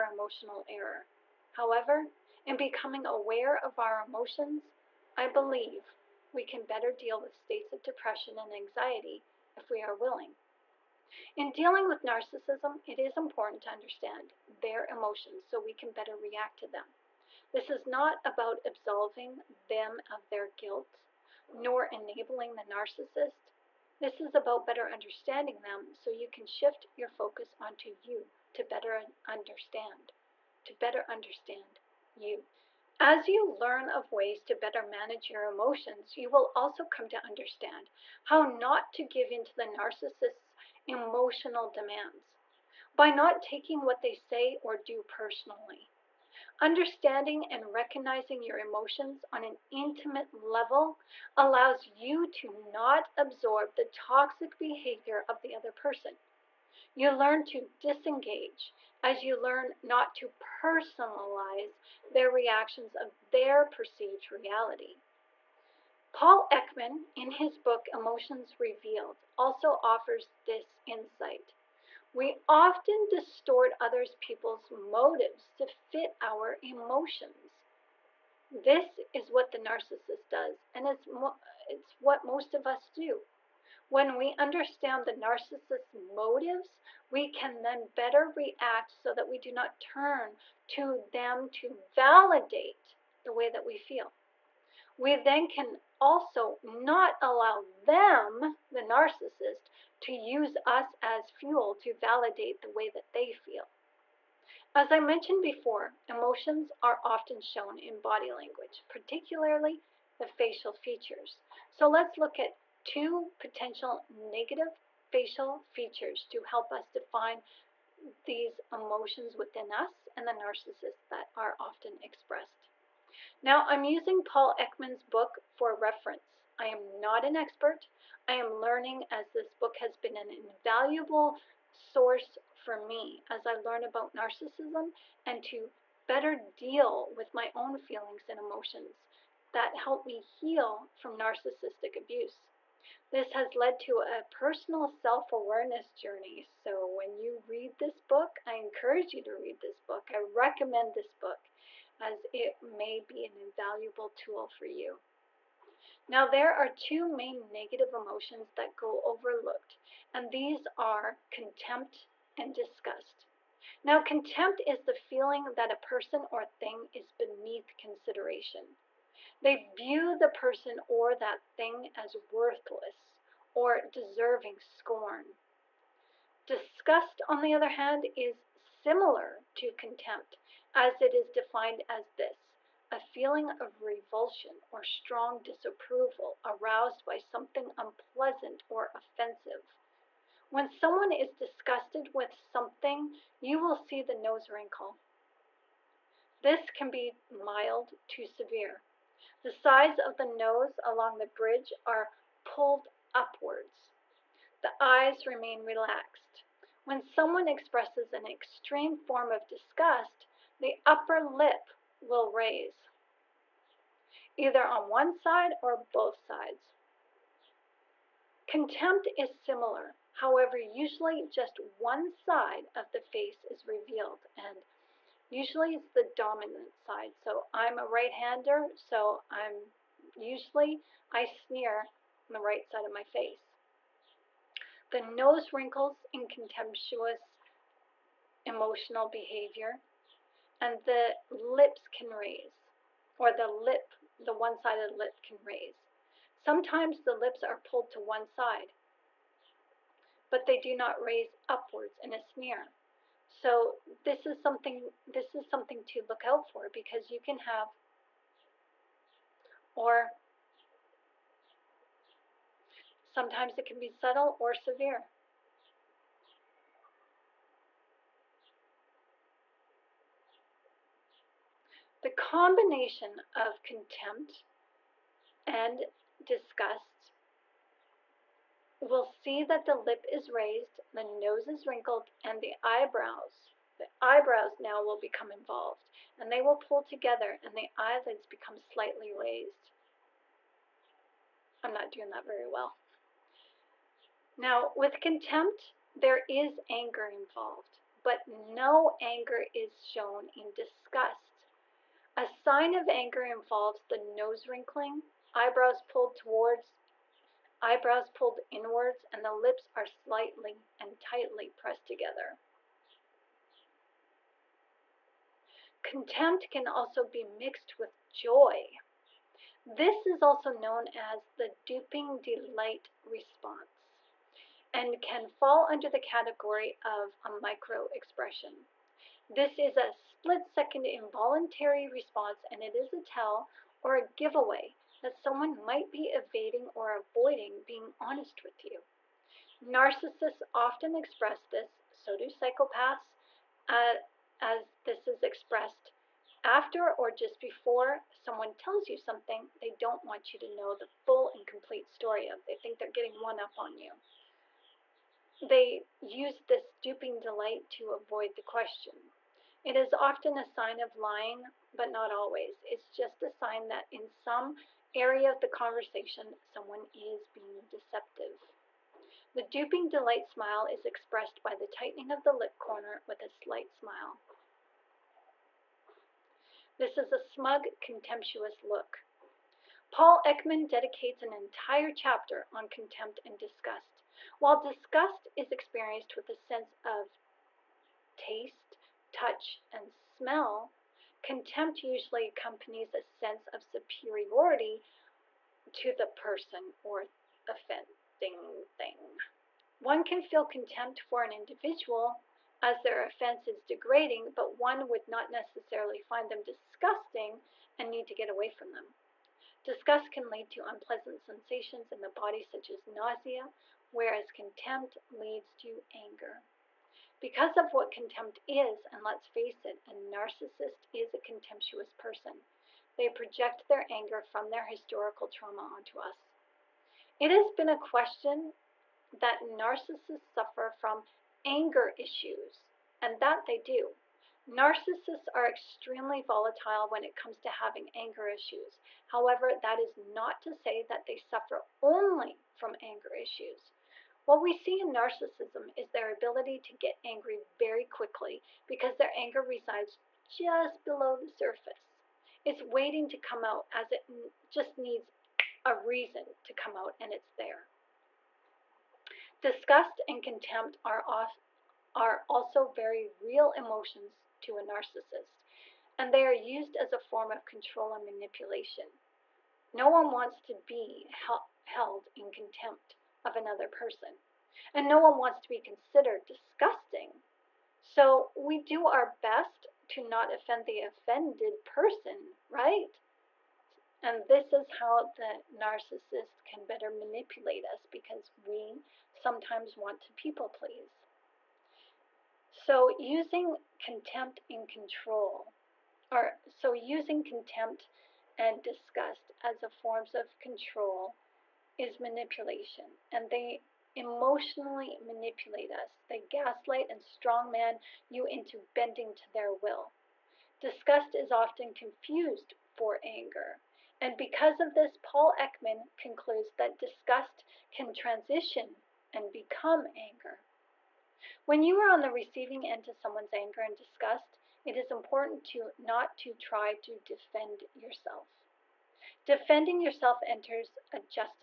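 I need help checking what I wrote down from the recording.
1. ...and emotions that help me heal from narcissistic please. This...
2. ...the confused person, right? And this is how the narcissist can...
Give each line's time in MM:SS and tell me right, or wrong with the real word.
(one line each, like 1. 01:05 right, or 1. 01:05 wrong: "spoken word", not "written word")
1. 02:18 wrong: "abuse", not "please"
2. 08:00 wrong: "offended", not "confused".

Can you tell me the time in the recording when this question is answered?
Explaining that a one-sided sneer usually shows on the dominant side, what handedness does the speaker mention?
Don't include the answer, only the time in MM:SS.
03:47.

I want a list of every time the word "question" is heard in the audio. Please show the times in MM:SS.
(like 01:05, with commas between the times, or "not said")
05:58, 07:07.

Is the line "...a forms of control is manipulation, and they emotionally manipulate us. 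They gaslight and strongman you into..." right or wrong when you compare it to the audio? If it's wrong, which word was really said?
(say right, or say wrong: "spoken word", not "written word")
right.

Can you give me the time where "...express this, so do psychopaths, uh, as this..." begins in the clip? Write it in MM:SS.
05:40.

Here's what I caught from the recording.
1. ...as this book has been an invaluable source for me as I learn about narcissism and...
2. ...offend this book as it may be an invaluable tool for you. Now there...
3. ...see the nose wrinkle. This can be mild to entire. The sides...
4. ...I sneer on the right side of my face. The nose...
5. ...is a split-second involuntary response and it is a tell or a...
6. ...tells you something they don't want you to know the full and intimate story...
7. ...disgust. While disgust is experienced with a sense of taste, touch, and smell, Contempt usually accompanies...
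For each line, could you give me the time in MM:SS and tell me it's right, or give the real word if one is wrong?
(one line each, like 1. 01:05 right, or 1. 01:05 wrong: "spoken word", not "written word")
1. 02:09 right
2. 02:30 wrong: "recommend", not "offend"
3. 03:13 wrong: "severe", not "entire"
4. 03:51 right
5. 05:29 right
6. 05:48 wrong: "complete", not "intimate"
7. 06:23 right.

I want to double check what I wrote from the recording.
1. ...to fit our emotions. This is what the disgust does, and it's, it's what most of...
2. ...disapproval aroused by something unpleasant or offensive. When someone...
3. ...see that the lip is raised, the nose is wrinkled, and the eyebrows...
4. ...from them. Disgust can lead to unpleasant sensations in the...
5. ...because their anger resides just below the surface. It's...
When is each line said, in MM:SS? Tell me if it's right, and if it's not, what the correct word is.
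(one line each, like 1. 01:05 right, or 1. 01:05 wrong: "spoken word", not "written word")
1. 01:15 wrong: "narcissist", not "disgust"
2. 03:05 right
3. 04:39 right
4. 06:48 right
5. 07:28 right.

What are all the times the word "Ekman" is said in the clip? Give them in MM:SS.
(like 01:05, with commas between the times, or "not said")
01:06, 02:04, 06:20, 08:35.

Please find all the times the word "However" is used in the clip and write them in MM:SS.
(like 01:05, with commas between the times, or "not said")
00:01, 03:40, 07:19.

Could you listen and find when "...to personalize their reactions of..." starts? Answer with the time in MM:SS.
01:00.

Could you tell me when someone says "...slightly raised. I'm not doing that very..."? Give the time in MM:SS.
04:48.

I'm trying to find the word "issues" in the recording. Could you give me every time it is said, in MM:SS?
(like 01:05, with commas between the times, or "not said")
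07:11, 07:18, 07:23.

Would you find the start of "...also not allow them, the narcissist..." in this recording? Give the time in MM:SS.
01:35.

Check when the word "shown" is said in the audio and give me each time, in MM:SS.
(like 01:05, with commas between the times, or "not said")
01:47, 04:59.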